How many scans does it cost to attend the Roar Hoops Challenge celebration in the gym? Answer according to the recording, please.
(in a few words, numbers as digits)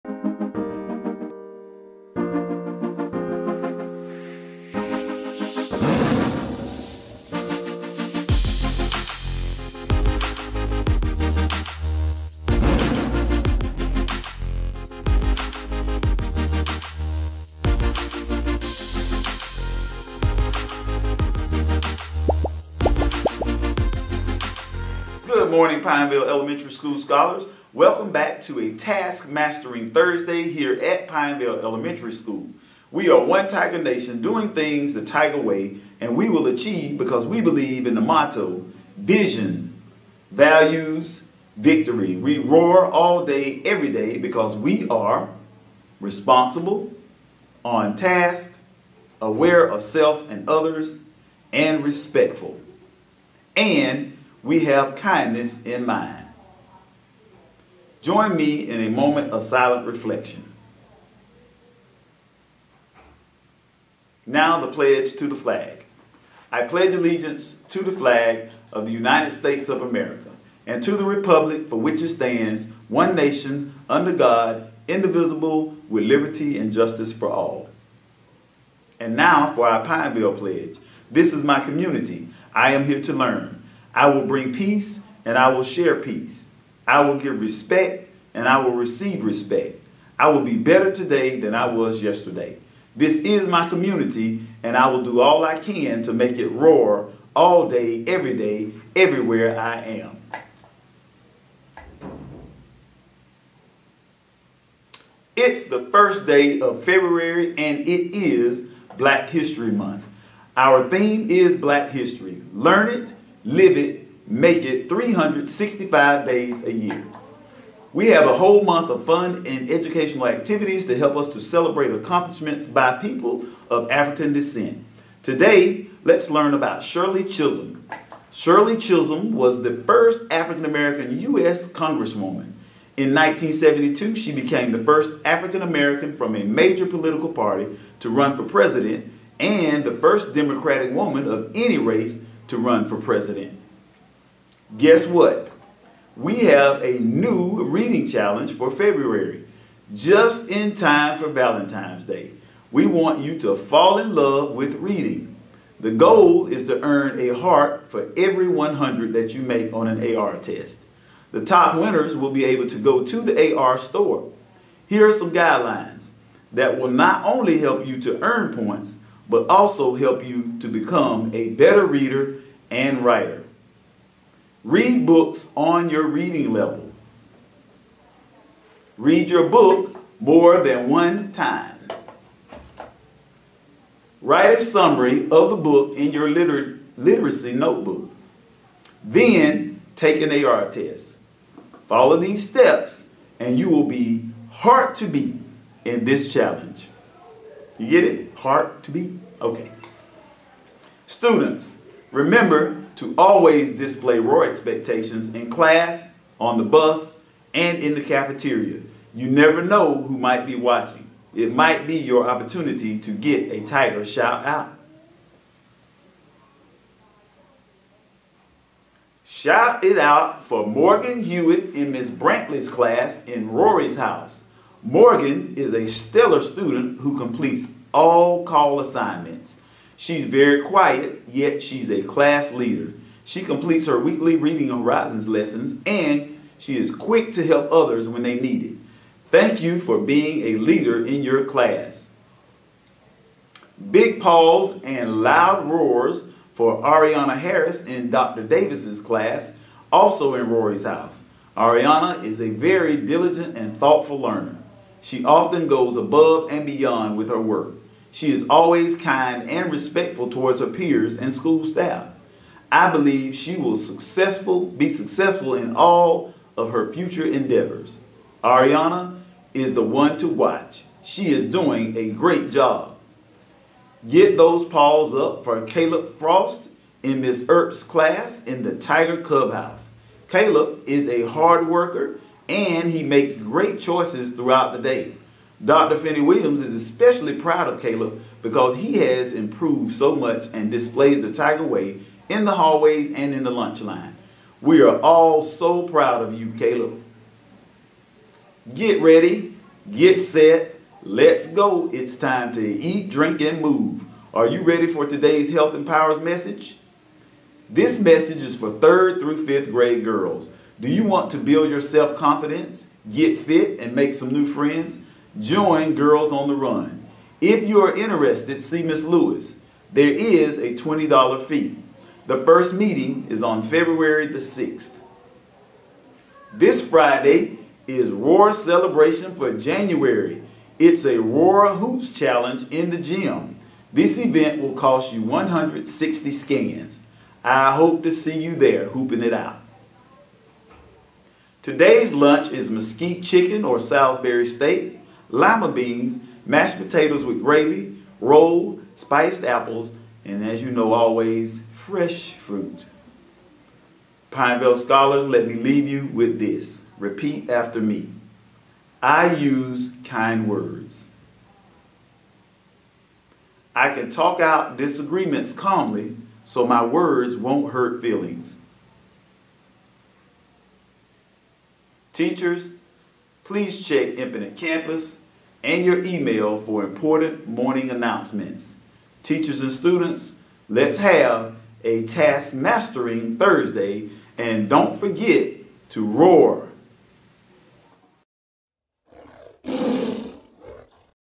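160.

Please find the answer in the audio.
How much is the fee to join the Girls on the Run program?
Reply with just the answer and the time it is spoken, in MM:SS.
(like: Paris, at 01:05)
$20, at 05:20.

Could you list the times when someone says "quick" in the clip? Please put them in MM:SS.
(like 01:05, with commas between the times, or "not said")
03:56.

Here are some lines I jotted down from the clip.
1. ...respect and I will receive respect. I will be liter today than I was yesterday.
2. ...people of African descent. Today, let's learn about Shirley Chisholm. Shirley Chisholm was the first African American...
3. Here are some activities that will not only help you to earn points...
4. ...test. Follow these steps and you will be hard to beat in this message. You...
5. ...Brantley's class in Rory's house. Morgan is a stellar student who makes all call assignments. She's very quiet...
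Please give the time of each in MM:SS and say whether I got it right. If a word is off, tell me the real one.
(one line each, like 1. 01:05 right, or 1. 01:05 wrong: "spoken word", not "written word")
1. 01:27 wrong: "better", not "liter"
2. 02:02 right
3. 02:44 wrong: "guidelines", not "activities"
4. 03:10 wrong: "challenge", not "message"
5. 03:42 wrong: "completes", not "makes".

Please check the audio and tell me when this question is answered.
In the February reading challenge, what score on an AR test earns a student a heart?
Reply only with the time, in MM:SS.
02:38.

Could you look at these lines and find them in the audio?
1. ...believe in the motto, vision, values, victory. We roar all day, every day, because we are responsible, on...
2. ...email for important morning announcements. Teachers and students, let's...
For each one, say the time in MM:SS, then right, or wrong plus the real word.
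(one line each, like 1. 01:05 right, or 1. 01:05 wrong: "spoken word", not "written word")
1. 00:37 right
2. 06:16 right.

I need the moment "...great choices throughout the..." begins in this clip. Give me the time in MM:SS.
04:43.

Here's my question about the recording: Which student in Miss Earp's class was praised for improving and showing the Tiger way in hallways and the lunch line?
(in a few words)
Caleb Frost.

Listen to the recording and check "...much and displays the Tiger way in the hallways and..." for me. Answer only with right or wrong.
right.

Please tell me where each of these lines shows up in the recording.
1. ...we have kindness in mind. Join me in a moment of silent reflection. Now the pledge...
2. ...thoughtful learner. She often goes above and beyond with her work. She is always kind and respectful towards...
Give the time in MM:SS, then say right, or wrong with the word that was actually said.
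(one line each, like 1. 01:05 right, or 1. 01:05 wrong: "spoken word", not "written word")
1. 00:54 right
2. 04:13 right.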